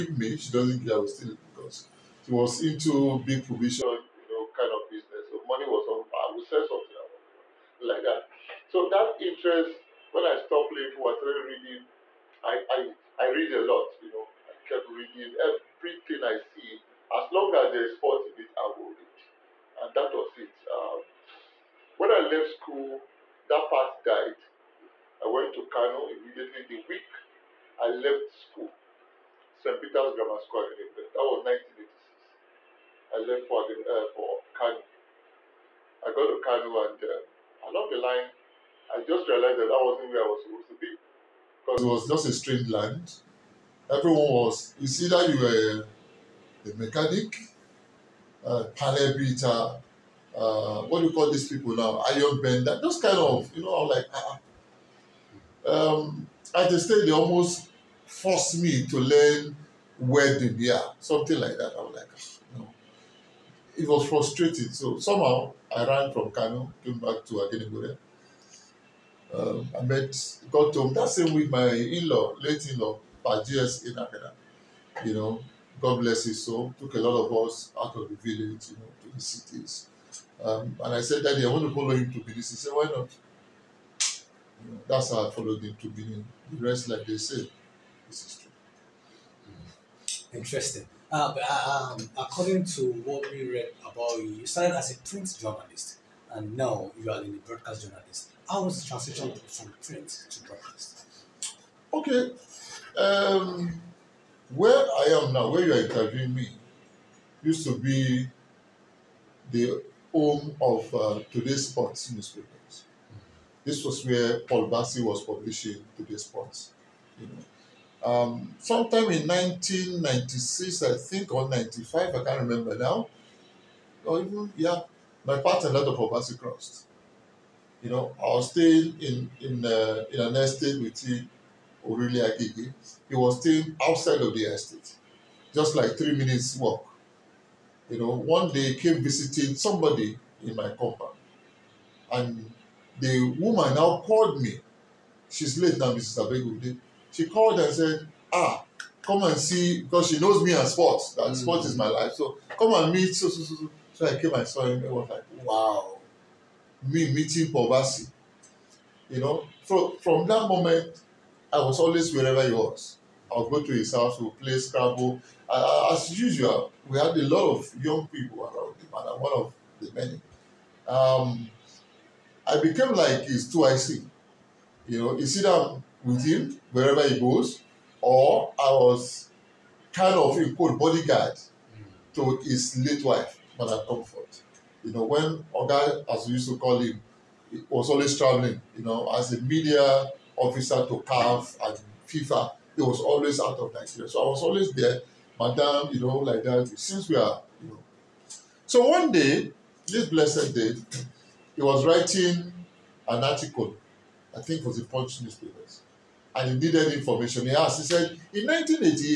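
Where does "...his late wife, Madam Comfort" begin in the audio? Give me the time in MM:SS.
03:02.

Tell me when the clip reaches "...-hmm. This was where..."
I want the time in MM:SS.
01:52.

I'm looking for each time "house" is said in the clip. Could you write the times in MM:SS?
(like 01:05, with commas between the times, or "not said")
02:43.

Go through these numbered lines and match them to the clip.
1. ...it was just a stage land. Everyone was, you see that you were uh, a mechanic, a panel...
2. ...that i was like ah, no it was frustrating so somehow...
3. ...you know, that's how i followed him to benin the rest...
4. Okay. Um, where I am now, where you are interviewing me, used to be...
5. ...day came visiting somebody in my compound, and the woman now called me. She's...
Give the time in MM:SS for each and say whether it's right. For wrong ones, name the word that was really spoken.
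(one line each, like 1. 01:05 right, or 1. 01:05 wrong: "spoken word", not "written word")
1. 00:41 wrong: "strange", not "stage"
2. 01:01 right
3. 01:24 right
4. 01:41 right
5. 02:18 right.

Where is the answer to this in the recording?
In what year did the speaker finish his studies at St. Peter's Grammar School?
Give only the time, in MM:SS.
00:31.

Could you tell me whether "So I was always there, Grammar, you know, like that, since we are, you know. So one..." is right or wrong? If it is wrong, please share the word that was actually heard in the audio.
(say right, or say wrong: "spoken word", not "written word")
wrong: "Madam", not "Grammar".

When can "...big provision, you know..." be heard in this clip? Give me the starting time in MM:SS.
00:03.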